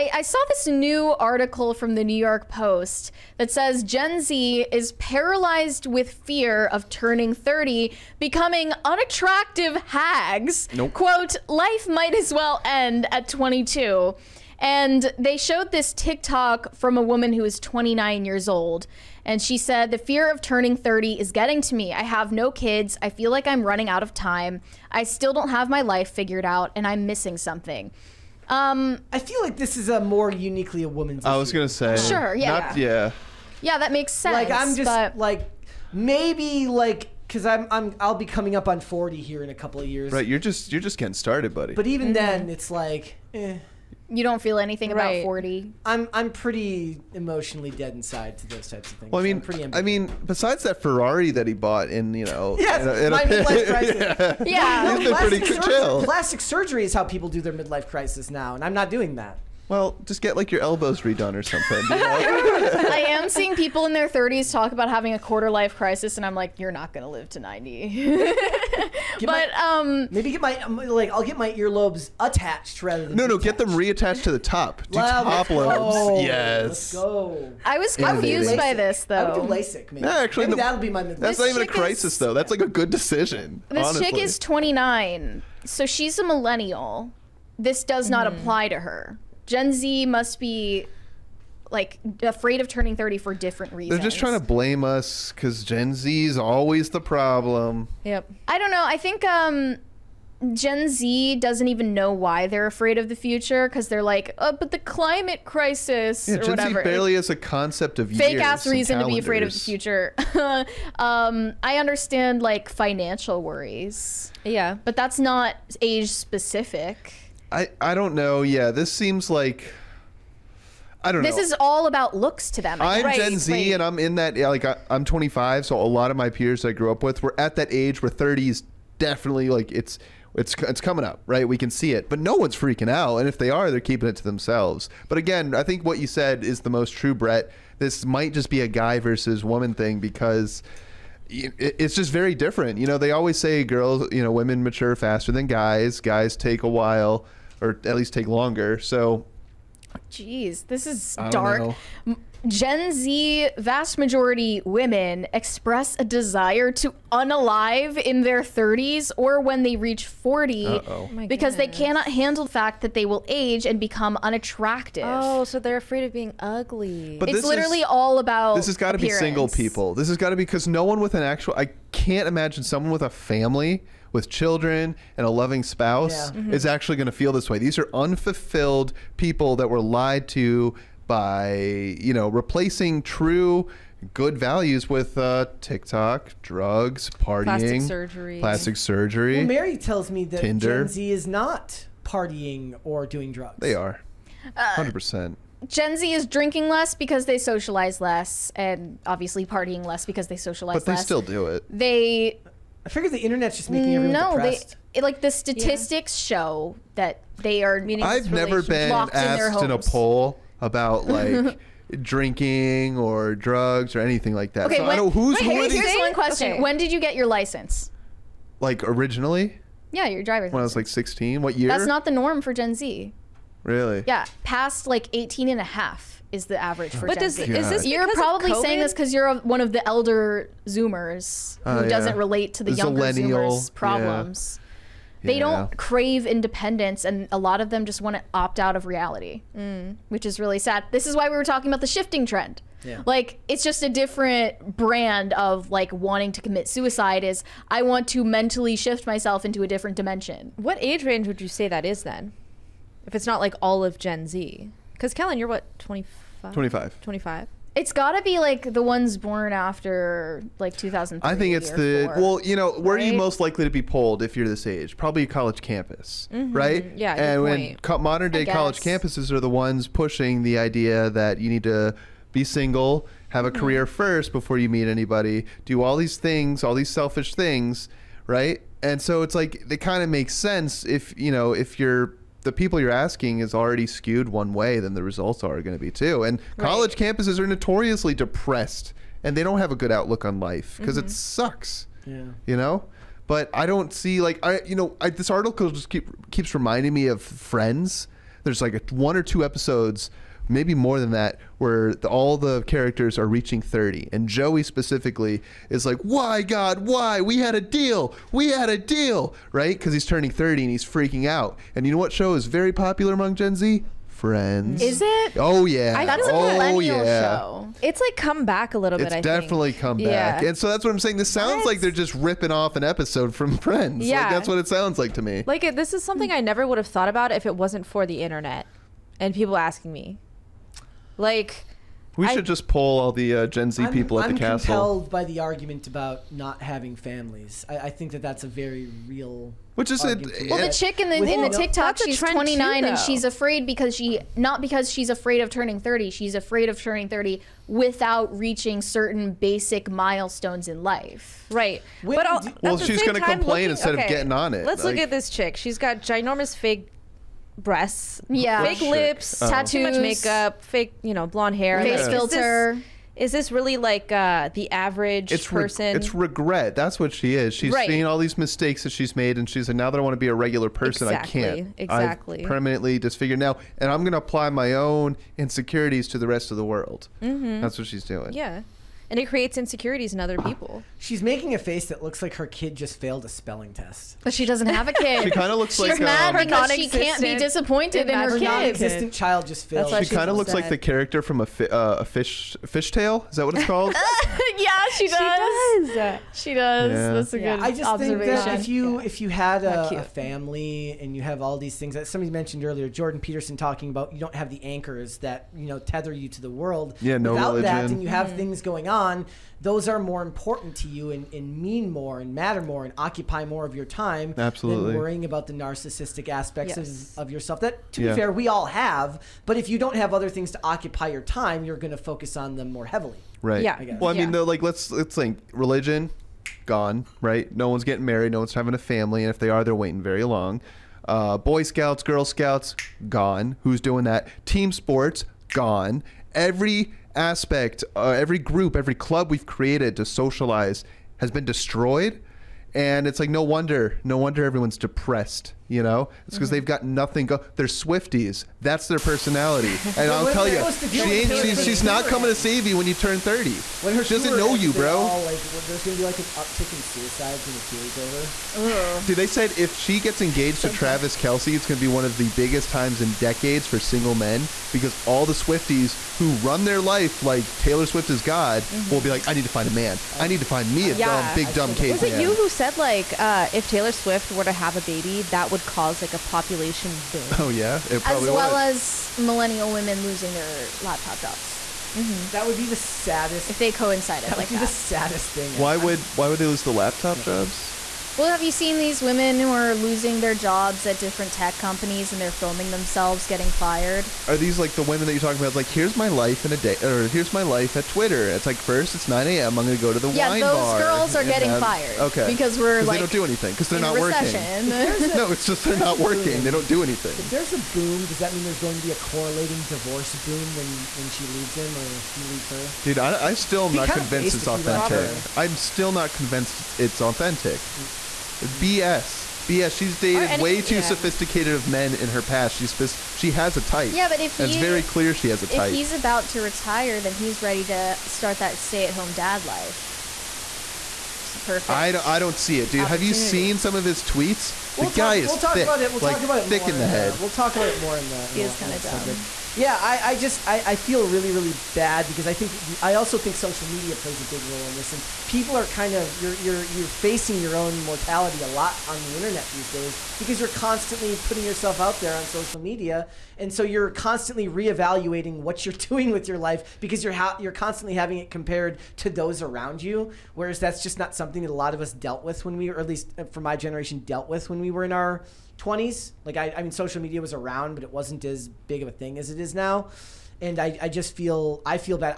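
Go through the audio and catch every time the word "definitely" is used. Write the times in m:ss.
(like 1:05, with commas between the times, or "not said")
2:08, 5:19.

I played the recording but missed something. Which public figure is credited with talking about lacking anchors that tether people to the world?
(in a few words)
Jordan Peterson.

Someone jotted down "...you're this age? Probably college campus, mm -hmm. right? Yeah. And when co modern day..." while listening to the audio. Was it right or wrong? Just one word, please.
right.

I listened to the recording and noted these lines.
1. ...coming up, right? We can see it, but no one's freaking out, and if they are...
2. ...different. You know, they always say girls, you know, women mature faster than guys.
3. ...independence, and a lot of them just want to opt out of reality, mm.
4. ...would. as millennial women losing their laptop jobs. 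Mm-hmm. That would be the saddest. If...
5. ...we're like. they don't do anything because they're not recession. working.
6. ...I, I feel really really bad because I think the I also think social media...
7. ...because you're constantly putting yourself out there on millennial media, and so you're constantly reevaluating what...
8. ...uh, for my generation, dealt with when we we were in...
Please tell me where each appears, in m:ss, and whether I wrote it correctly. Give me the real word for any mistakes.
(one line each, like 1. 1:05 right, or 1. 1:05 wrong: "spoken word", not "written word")
1. 2:10 right
2. 2:22 right
3. 3:56 right
4. 7:58 right
5. 8:22 right
6. 9:00 right
7. 9:10 wrong: "social", not "millennial"
8. 9:23 right.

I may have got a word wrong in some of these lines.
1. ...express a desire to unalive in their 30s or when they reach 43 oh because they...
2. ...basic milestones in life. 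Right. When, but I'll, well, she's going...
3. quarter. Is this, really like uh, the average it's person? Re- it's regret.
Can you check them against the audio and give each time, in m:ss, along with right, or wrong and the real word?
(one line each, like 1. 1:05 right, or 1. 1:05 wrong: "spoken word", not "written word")
1. 2:35 wrong: "40", not "43"
2. 5:49 right
3. 6:02 wrong: "filter", not "quarter".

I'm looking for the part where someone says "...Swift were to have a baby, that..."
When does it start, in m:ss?
7:53.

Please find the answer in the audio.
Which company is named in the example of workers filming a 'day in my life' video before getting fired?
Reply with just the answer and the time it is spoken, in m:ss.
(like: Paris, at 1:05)
Twitter, at 8:17.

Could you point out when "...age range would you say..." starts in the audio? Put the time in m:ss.
4:10.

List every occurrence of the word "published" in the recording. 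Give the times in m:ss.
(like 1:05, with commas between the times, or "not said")
not said.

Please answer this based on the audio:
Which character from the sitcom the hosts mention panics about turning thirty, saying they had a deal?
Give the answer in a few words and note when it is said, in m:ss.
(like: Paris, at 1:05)
Joey, at 5:04.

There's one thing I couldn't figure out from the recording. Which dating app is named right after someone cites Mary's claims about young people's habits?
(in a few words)
Tinder.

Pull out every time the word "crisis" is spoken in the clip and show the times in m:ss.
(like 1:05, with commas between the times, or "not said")
0:53, 0:57, 1:05, 1:21, 1:45.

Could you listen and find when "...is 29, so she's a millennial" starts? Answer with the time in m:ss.
1:24.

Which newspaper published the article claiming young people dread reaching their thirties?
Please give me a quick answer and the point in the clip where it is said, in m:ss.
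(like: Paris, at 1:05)
New York Post, at 0:02.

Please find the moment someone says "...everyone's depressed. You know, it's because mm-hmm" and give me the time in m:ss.
7:24.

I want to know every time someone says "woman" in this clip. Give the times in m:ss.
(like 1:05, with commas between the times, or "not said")
0:17, 0:30, 2:19.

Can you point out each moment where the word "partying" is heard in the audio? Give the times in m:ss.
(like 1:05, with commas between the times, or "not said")
3:07, 3:12, 3:19.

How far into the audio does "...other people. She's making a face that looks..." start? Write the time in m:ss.
6:20.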